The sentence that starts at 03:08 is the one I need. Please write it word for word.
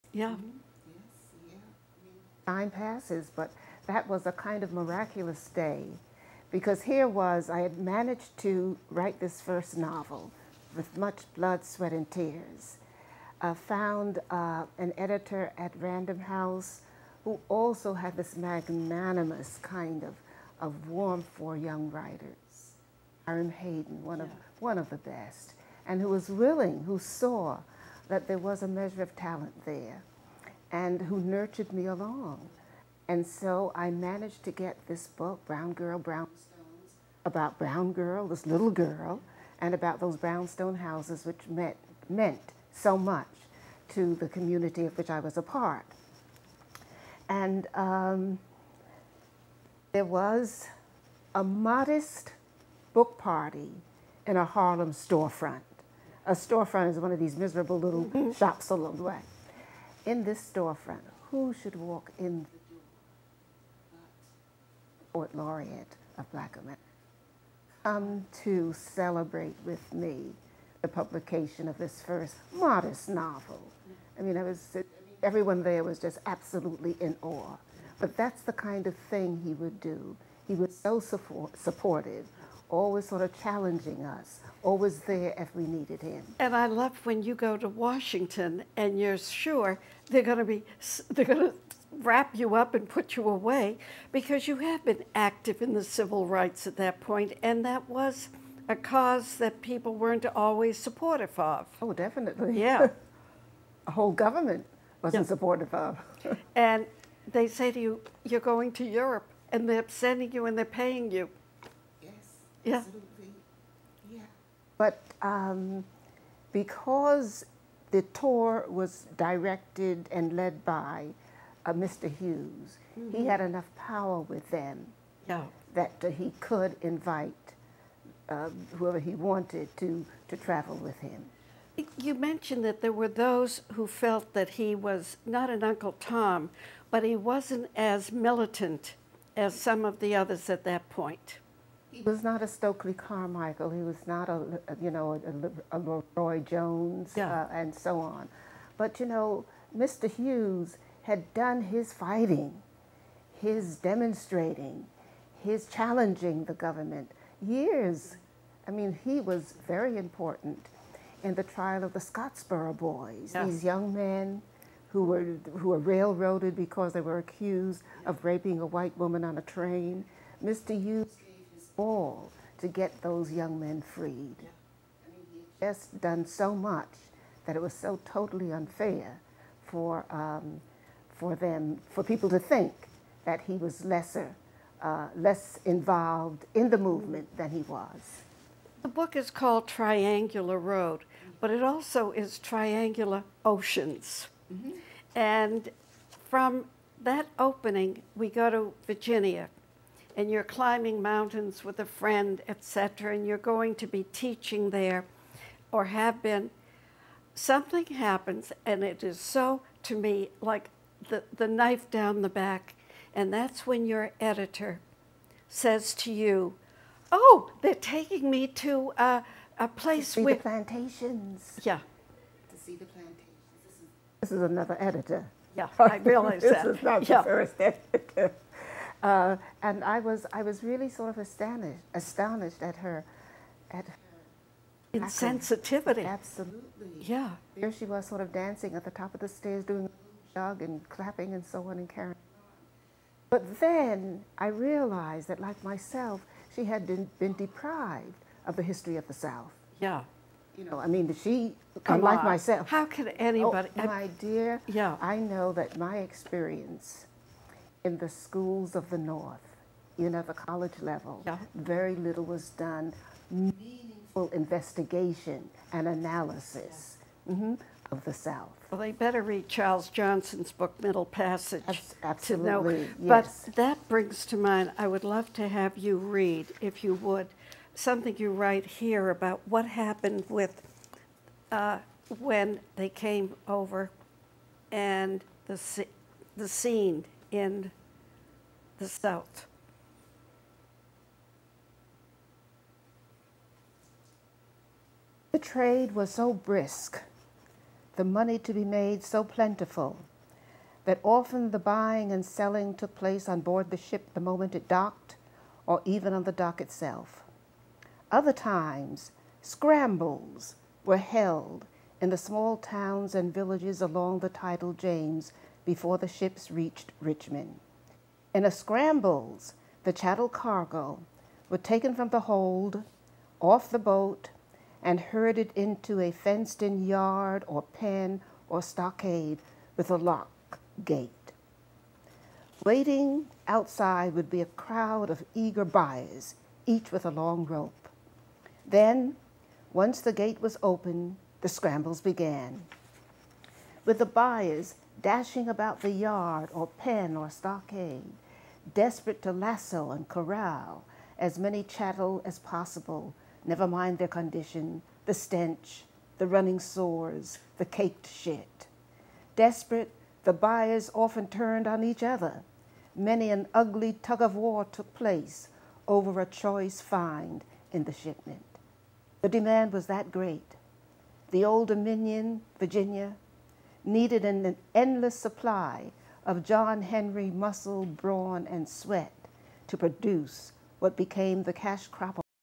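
The book is called Triangular Road, but it also is Triangular Oceans.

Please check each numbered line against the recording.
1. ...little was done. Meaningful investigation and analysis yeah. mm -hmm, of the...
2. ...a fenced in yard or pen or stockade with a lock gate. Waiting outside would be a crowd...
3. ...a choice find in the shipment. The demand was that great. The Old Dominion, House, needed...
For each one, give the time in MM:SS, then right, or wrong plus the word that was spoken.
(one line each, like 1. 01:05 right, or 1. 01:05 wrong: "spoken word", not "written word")
1. 04:21 right
2. 05:25 right
3. 06:06 wrong: "Virginia", not "House".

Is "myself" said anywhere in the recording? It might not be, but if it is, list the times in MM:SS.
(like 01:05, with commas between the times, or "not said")
04:05, 04:12.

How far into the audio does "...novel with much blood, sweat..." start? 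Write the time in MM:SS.
00:09.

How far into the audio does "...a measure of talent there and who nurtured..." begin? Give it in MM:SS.
00:28.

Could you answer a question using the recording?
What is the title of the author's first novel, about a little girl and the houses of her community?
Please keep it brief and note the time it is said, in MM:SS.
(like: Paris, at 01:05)
Brown Girl, Brownstones, at 00:35.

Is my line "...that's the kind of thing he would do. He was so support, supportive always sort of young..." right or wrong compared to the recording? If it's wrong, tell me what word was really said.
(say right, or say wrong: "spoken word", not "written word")
wrong: "challenging", not "young".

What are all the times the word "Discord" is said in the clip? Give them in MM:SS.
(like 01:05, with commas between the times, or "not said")
not said.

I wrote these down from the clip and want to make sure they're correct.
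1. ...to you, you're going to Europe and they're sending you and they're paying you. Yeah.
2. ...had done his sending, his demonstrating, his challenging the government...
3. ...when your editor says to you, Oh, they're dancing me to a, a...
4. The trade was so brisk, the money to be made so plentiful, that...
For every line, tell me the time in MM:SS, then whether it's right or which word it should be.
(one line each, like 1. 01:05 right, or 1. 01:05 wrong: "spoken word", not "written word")
1. 01:47 right
2. 02:31 wrong: "fighting", not "sending"
3. 03:33 wrong: "taking", not "dancing"
4. 04:55 right.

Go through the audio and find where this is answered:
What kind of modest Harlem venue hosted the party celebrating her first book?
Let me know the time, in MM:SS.
00:54.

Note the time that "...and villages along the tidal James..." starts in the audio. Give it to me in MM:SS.
05:13.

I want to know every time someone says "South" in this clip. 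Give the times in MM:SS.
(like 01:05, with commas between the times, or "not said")
04:09, 04:28, 04:48.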